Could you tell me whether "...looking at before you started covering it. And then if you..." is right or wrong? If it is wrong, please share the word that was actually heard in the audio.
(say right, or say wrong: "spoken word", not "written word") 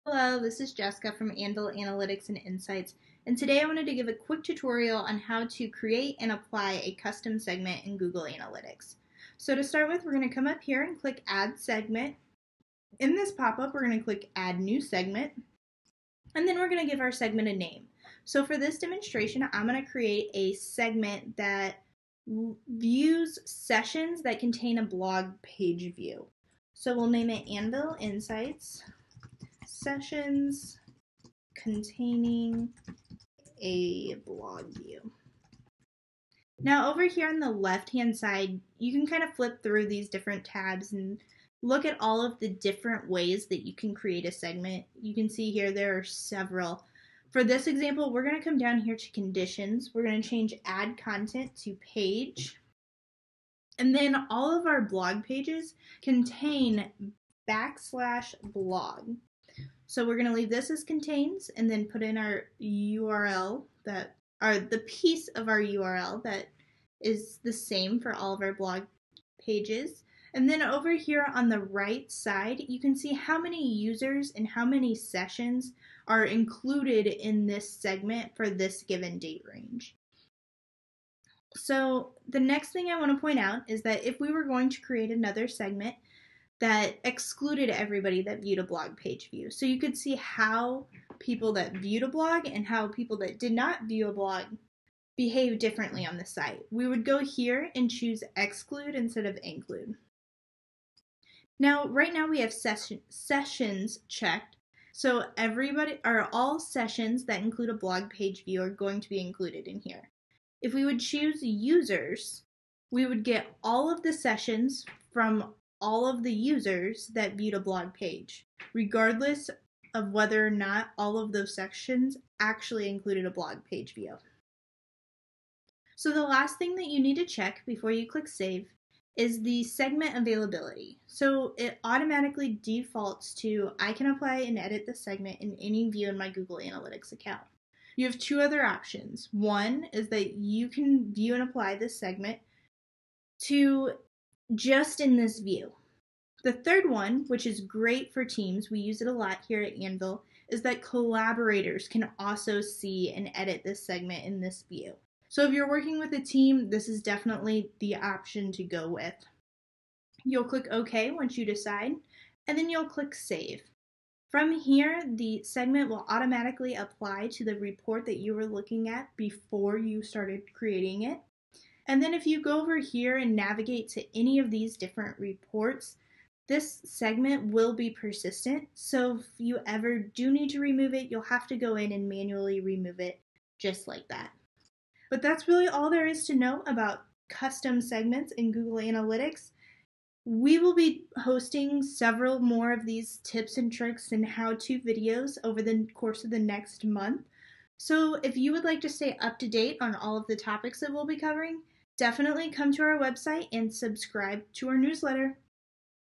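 wrong: "creating", not "covering".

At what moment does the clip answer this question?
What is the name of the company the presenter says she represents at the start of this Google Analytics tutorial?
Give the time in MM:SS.
00:01.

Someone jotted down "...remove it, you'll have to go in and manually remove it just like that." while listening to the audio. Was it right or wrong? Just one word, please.
right.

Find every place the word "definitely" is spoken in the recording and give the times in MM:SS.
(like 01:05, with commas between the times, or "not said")
02:37, 03:21.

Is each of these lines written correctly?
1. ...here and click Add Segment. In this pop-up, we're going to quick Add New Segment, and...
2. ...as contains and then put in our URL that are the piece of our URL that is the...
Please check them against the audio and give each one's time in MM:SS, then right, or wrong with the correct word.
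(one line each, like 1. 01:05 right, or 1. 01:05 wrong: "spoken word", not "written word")
1. 00:10 wrong: "click", not "quick"
2. 01:00 right.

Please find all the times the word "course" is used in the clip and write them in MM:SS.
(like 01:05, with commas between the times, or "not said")
03:15.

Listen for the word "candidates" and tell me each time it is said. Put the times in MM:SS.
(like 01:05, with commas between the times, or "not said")
not said.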